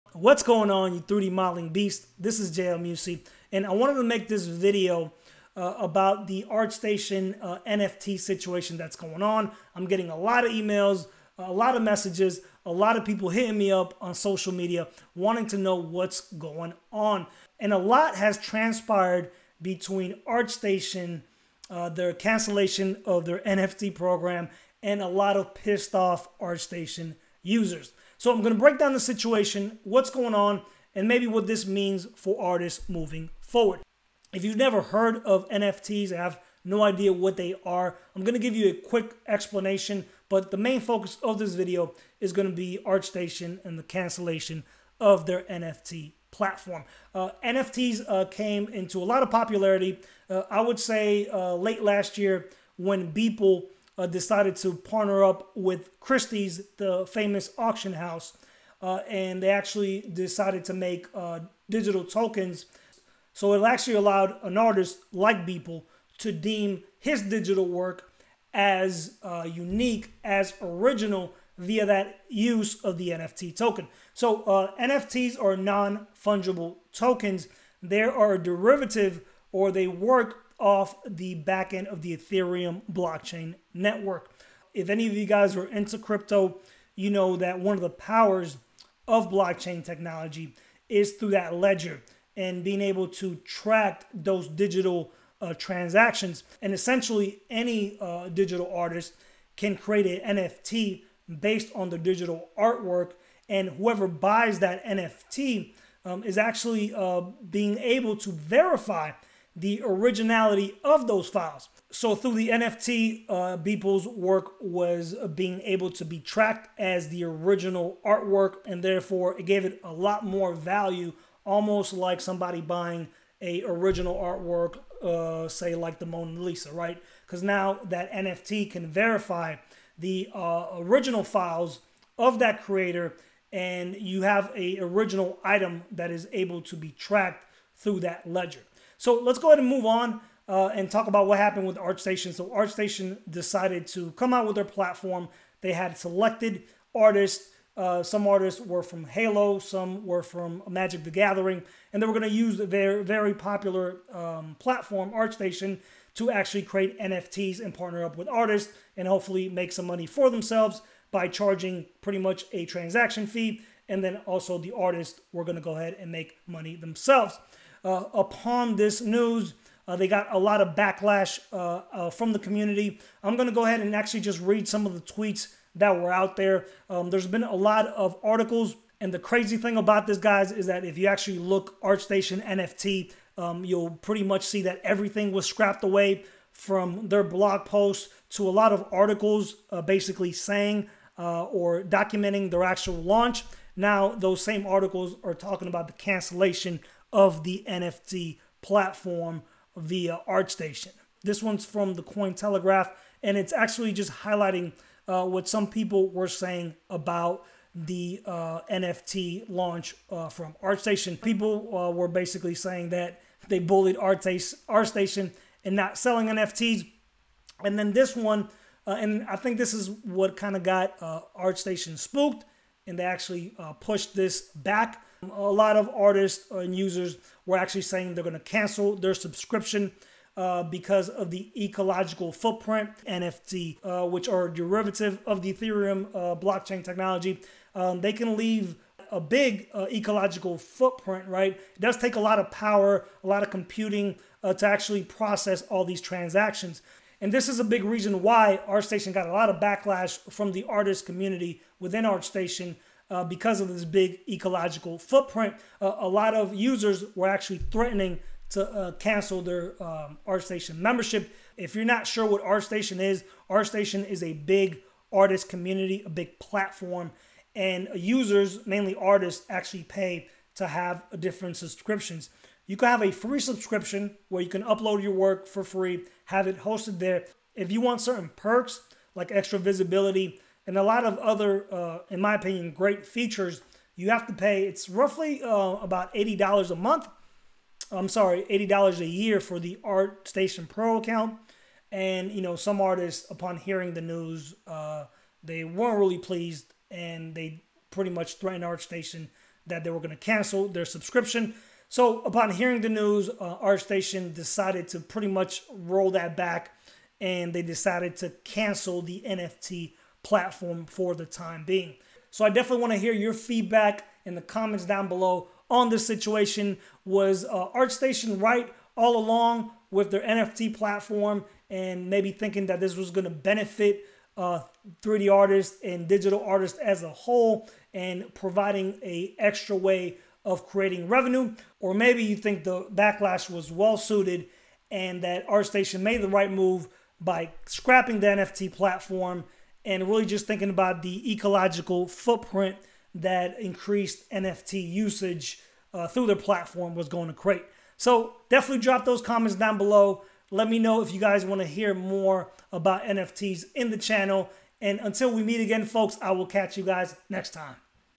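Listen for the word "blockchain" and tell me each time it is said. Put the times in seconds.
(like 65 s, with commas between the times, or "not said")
82 s, 89 s, 236 s.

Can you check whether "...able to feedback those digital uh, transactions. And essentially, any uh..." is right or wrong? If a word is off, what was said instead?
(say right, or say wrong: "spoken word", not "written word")
wrong: "track", not "feedback".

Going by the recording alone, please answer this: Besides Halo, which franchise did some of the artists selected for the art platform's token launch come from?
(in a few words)
Magic the Gathering.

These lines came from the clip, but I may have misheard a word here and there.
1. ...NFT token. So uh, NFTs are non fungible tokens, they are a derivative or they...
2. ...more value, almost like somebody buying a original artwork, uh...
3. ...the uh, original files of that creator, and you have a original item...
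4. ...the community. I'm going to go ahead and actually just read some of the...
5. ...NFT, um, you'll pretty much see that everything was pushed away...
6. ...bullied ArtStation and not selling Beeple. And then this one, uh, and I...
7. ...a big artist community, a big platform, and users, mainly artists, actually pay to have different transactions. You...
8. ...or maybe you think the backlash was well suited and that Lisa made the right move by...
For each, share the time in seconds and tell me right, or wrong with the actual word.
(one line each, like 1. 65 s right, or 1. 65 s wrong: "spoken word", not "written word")
1. 73 s right
2. 120 s right
3. 129 s right
4. 172 s right
5. 182 s wrong: "scrapped", not "pushed"
6. 213 s wrong: "NFTs", not "Beeple"
7. 264 s wrong: "subscriptions", not "transactions"
8. 331 s wrong: "ArtStation", not "Lisa".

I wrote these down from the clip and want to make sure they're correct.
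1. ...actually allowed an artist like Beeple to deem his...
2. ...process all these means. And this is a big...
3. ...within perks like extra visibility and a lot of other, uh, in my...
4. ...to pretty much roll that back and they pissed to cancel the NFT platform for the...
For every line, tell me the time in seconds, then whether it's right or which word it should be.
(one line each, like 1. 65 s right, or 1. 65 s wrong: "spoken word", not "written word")
1. 63 s right
2. 245 s wrong: "transactions", not "means"
3. 278 s wrong: "certain", not "within"
4. 304 s wrong: "decided", not "pissed".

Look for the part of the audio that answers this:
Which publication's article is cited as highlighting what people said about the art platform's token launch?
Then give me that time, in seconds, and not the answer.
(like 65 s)
202 s.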